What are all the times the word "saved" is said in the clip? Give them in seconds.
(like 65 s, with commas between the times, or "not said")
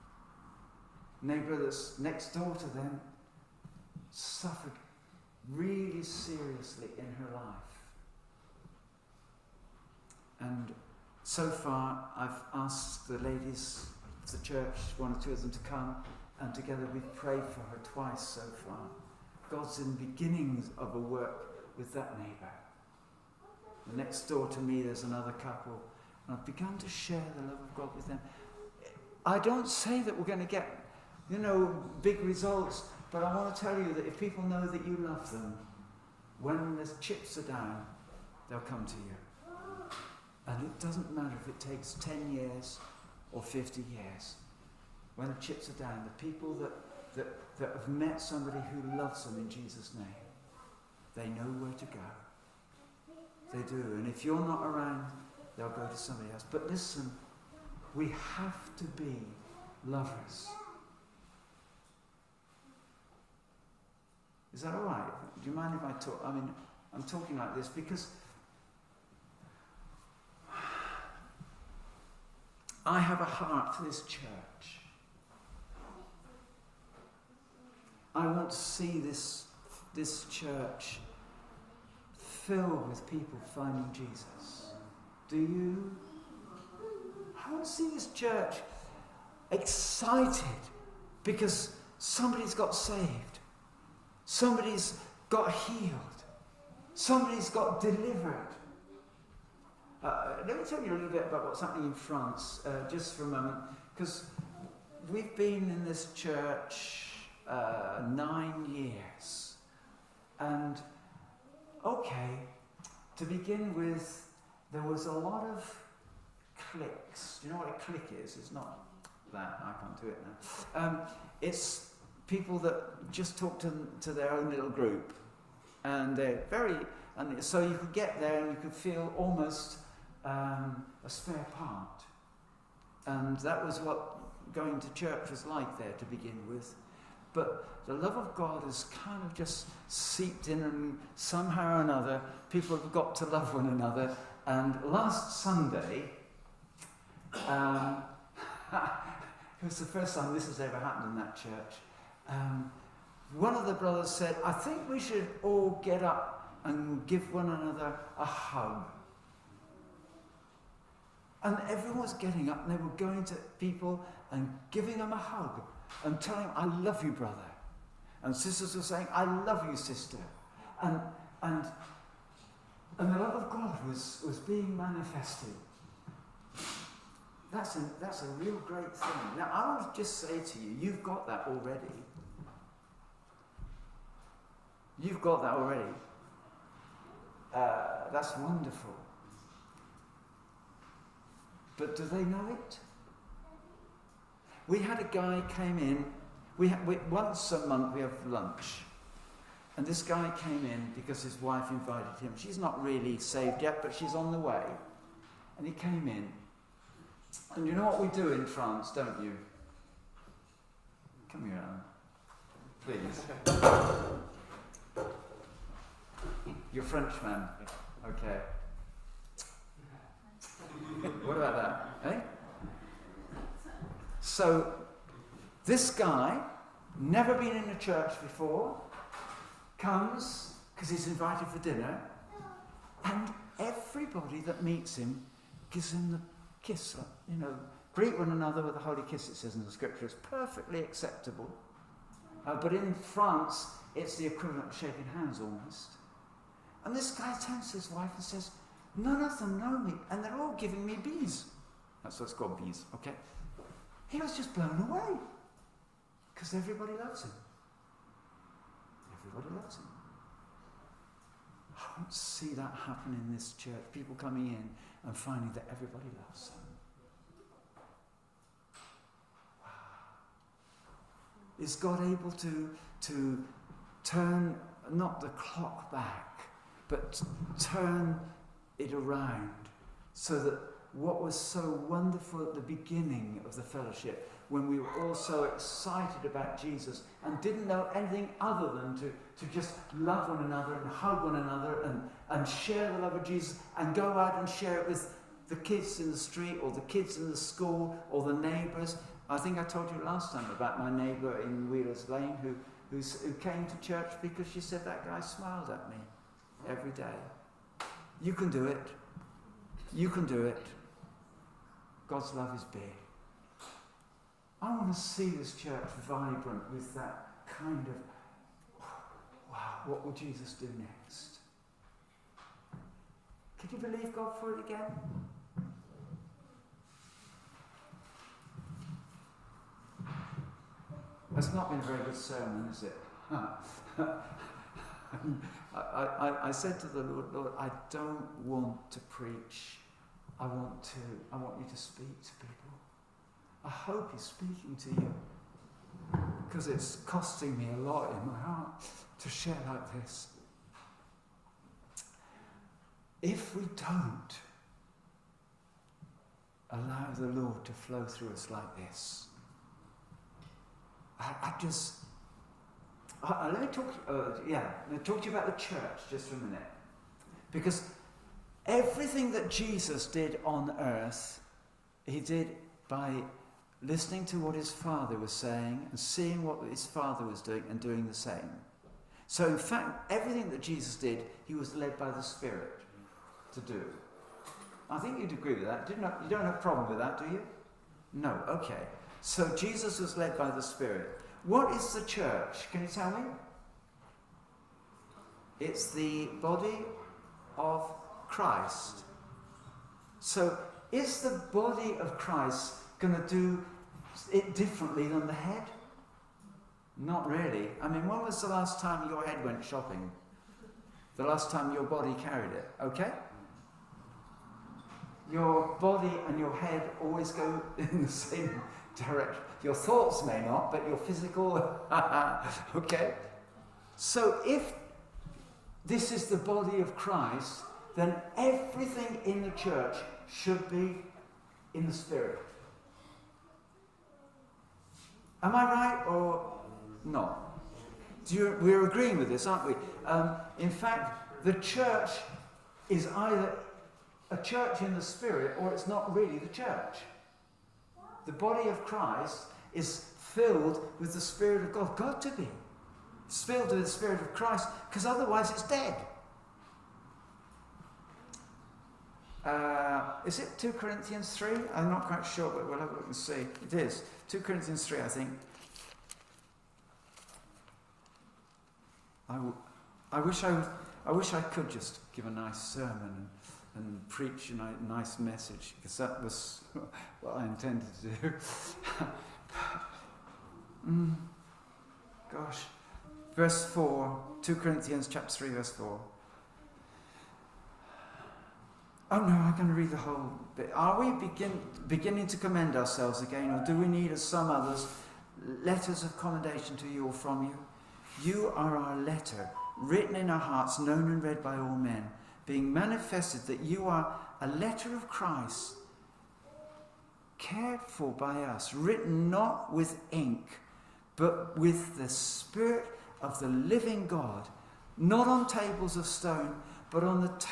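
92 s, 203 s.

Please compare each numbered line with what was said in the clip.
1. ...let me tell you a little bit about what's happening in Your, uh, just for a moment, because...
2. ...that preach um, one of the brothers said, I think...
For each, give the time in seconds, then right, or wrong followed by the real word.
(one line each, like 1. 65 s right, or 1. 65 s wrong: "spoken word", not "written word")
1. 100 s wrong: "France", not "Your"
2. 151 s wrong: "church", not "preach".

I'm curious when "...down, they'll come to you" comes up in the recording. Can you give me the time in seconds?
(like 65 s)
37 s.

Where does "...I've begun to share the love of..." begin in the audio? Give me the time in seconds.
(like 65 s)
26 s.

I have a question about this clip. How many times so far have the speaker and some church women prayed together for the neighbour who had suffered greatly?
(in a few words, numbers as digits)
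Twice.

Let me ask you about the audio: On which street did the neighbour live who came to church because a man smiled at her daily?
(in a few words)
Wheelers Lane.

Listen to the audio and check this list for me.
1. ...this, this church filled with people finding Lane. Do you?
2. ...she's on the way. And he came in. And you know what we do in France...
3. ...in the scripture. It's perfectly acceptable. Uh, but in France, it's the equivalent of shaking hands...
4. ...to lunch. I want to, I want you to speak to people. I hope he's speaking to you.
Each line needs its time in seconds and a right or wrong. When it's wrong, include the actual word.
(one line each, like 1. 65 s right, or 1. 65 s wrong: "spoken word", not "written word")
1. 78 s wrong: "Jesus", not "Lane"
2. 203 s right
3. 239 s right
4. 338 s wrong: "preach", not "lunch".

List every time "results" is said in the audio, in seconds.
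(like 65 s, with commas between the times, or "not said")
32 s.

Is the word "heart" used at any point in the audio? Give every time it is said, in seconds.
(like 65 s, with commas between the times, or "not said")
73 s, 348 s, 500 s.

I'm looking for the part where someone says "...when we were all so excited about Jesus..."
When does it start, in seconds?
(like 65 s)
284 s.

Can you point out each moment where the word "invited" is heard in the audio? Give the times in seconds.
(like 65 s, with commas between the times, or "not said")
201 s, 231 s.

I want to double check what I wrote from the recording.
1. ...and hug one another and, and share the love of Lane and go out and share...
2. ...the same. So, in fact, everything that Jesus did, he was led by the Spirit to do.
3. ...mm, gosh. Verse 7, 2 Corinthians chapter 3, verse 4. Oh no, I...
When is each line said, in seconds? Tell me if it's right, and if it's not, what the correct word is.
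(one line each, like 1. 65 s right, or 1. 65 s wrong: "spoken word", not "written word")
1. 290 s wrong: "Jesus", not "Lane"
2. 378 s right
3. 480 s wrong: "4", not "7".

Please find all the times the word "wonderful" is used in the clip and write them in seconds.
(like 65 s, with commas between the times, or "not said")
188 s, 281 s.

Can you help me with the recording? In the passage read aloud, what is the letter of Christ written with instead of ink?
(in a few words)
Spirit of the living God.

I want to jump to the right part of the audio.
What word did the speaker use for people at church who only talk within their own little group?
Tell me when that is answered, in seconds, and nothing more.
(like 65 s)
117 s.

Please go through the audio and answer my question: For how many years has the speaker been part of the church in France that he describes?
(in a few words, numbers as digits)
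9.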